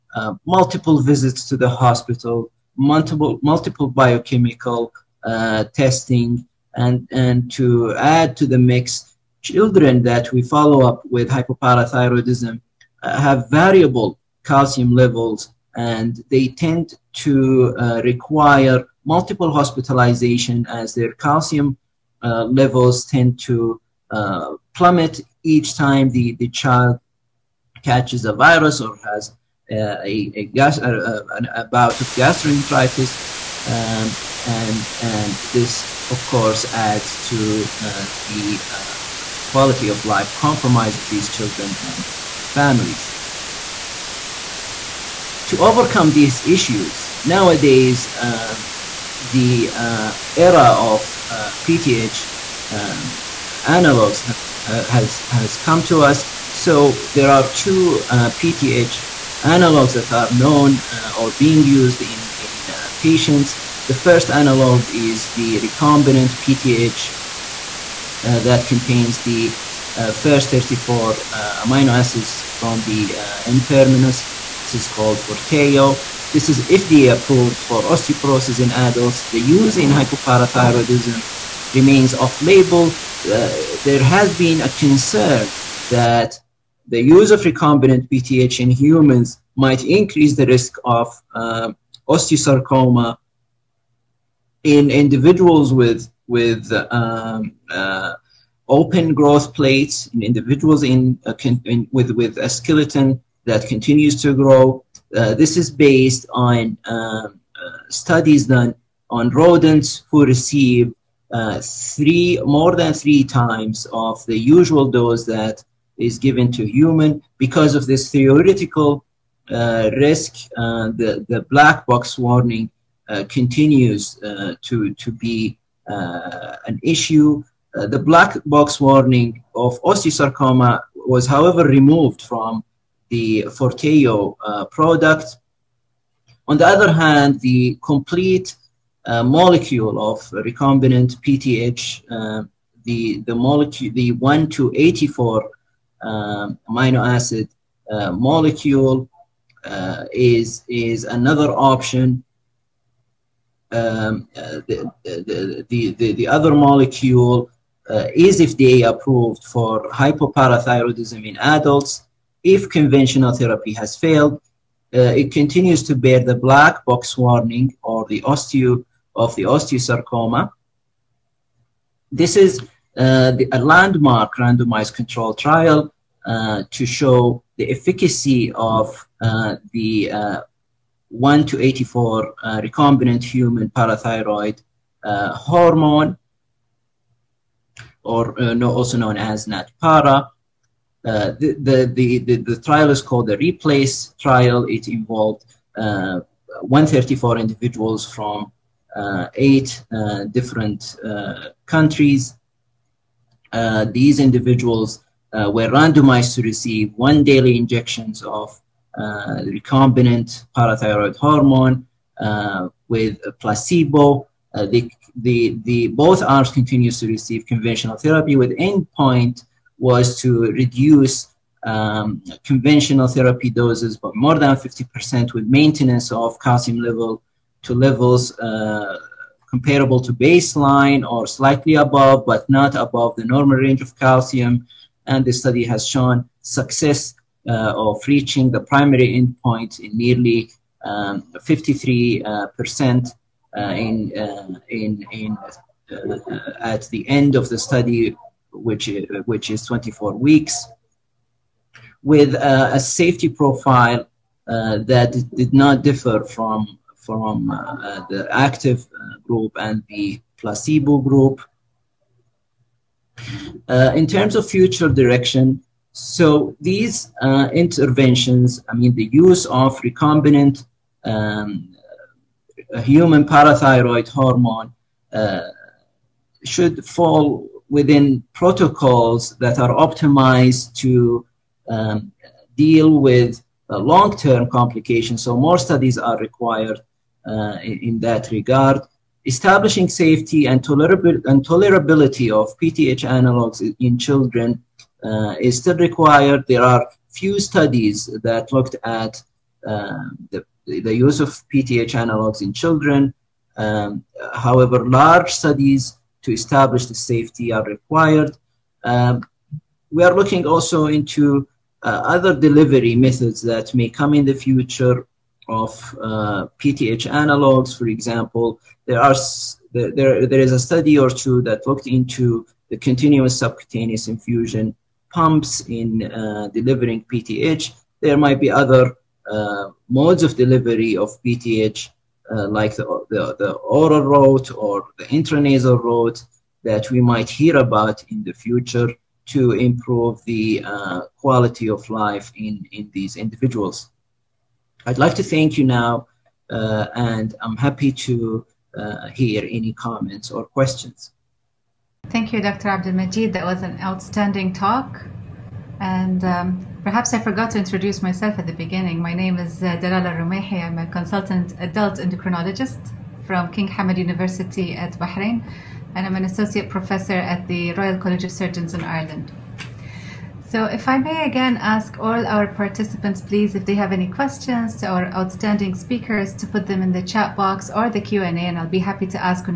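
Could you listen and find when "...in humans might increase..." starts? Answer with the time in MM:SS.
01:28.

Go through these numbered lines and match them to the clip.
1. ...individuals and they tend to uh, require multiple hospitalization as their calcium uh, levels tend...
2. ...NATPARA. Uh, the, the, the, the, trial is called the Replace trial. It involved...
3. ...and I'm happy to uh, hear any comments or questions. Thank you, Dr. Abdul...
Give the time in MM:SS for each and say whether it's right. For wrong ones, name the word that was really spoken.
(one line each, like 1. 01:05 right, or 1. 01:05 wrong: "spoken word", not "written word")
1. 00:14 wrong: "levels", not "individuals"
2. 03:09 right
3. 05:46 right.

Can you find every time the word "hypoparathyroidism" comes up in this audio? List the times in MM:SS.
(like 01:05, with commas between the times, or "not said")
00:11, 01:19, 02:39.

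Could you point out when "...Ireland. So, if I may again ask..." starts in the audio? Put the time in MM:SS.
06:08.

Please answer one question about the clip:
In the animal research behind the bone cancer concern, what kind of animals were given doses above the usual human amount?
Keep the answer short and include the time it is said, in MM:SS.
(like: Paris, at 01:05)
rodents, at 01:49.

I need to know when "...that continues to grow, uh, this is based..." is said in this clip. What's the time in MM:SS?
01:43.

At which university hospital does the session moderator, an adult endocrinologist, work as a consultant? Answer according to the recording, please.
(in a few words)
King Hamad University.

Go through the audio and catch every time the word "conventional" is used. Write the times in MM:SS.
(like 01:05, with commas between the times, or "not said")
02:42, 03:37, 03:42.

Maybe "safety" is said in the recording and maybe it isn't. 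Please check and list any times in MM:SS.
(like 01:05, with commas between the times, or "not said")
04:12, 04:49, 05:06.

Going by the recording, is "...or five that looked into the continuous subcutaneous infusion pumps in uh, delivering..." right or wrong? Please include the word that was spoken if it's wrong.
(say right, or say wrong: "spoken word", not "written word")
wrong: "two", not "five".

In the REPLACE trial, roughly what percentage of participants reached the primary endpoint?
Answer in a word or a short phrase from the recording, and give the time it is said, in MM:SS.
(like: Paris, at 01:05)
53%, at 04:01.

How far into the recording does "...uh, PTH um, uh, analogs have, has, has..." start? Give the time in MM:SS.
00:51.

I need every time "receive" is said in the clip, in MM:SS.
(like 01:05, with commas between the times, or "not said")
01:50, 03:26, 03:37.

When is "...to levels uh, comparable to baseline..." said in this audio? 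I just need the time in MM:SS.
03:47.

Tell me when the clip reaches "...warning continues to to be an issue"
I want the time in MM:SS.
02:02.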